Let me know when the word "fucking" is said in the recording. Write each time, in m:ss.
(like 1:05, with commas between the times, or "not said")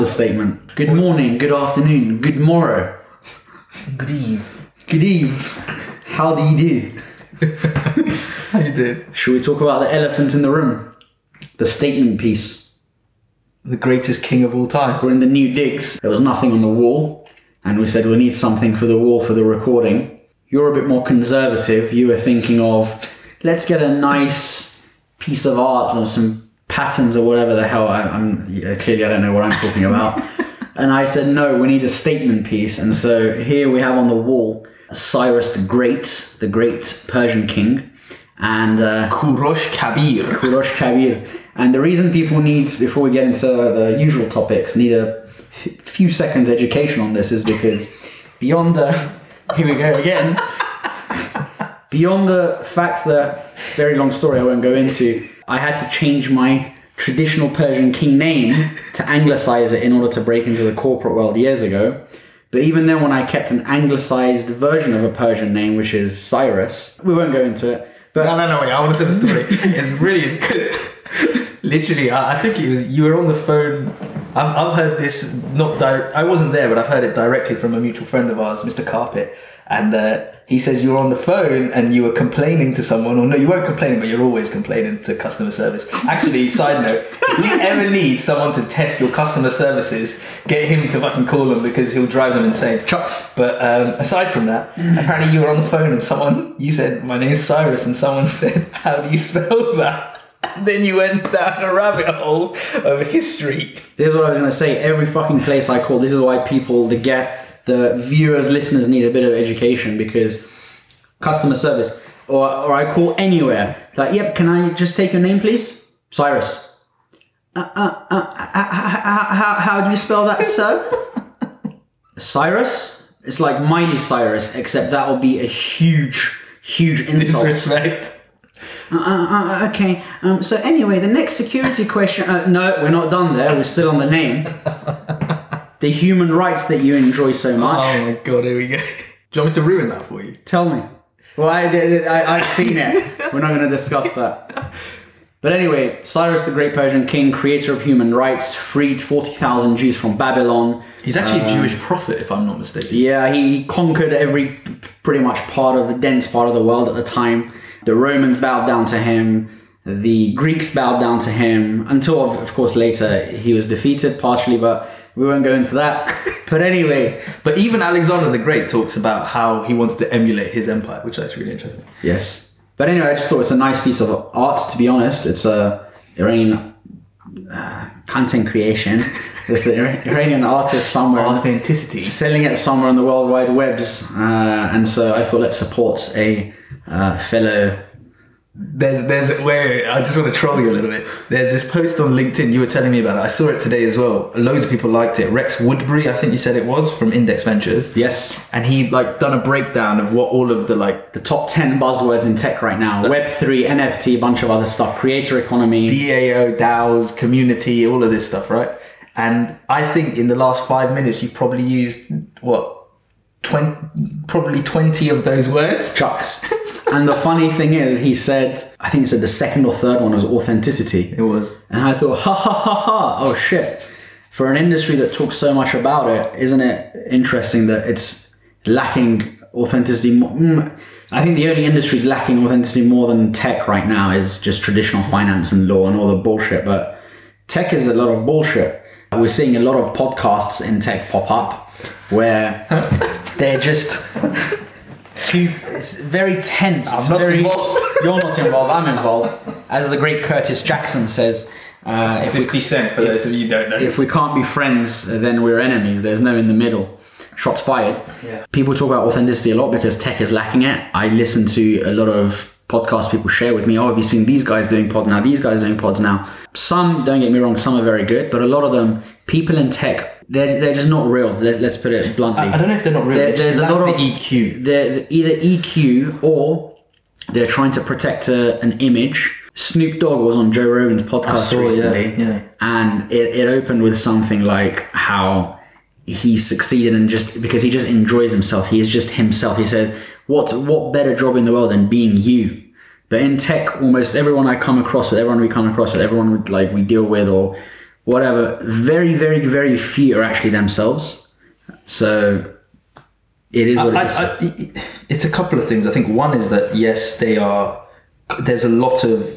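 1:30, 1:45.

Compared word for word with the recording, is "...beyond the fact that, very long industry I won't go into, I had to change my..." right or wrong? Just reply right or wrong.
wrong.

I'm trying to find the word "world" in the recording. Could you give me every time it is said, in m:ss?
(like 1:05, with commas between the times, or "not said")
1:01, 2:36, 3:03, 4:51.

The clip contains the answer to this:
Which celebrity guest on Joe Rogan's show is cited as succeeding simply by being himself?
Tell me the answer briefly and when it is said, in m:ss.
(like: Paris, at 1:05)
Snoop Dogg, at 4:39.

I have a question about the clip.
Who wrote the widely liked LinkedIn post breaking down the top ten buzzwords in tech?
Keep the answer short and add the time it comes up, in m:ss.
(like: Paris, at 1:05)
Rex Woodbury, at 3:15.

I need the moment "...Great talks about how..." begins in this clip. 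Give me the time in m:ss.
2:48.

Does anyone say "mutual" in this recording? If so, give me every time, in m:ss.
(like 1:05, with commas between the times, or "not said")
1:17.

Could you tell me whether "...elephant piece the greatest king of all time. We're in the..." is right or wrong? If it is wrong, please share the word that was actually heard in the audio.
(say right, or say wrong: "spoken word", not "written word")
wrong: "statement", not "elephant".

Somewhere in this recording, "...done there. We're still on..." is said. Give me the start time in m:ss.
2:13.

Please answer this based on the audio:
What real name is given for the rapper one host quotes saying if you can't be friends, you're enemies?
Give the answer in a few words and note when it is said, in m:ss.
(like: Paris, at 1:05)
Curtis Jackson, at 4:10.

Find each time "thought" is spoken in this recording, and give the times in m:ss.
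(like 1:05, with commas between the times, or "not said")
2:53, 3:05, 3:41.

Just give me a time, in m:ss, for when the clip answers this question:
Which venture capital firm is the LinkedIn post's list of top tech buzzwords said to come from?
3:17.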